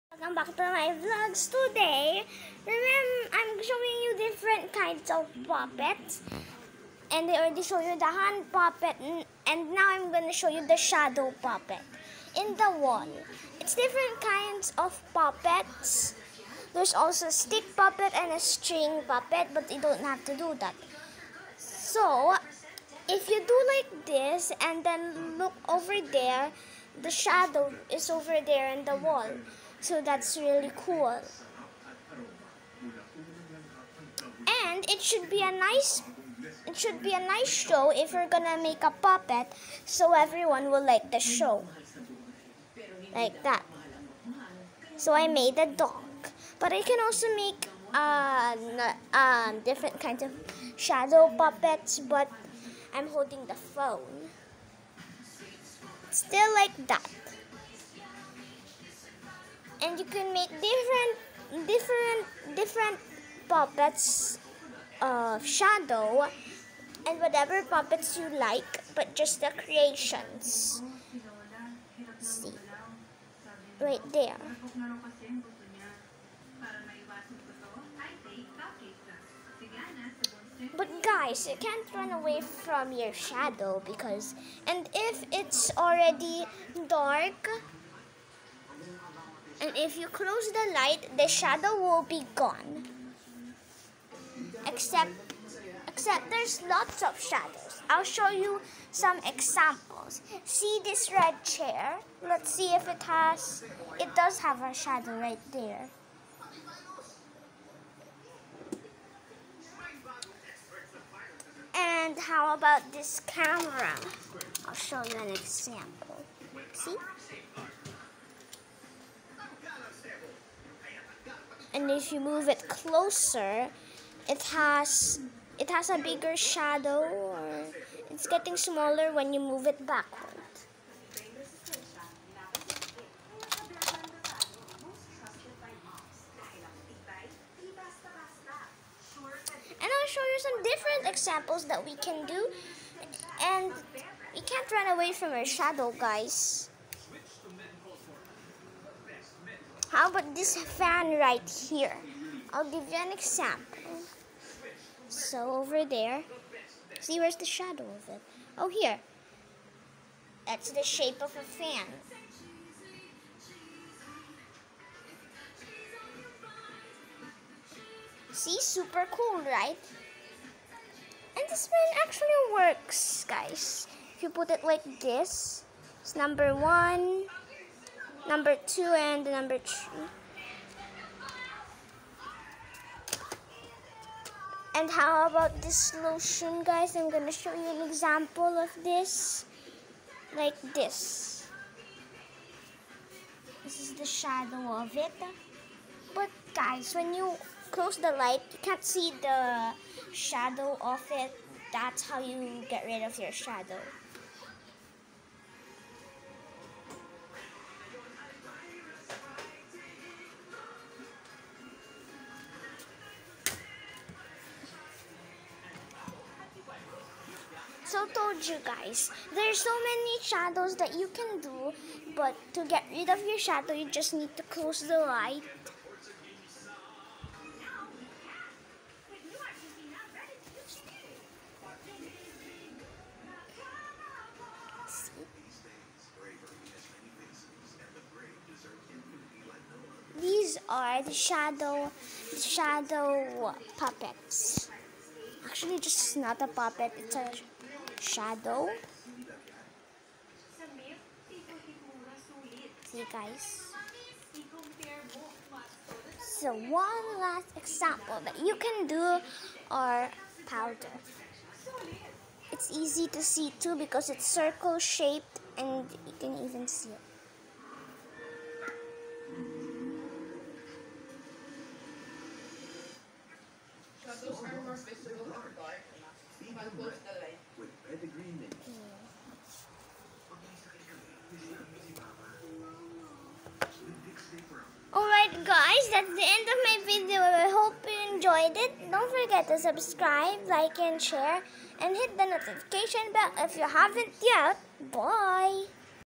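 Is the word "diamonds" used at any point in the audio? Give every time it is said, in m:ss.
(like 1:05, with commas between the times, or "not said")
not said.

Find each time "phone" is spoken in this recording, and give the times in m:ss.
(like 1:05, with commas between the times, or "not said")
0:53.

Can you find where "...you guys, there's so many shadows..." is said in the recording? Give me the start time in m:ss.
3:38.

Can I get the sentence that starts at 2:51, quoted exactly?
And this fan actually works, guys.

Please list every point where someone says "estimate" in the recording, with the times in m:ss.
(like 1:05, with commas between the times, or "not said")
not said.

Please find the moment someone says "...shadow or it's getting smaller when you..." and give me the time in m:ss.
2:06.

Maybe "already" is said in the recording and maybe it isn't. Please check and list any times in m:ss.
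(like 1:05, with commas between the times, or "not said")
0:07, 1:25.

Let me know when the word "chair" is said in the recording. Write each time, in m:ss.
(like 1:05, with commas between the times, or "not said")
1:41.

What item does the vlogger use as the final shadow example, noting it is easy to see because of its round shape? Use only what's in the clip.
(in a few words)
powder.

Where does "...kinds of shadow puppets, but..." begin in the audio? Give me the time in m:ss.
0:49.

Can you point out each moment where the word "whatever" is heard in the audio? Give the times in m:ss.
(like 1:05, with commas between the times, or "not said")
1:07.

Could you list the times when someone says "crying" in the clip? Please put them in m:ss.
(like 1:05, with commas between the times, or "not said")
not said.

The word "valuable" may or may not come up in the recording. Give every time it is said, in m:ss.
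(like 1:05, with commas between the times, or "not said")
not said.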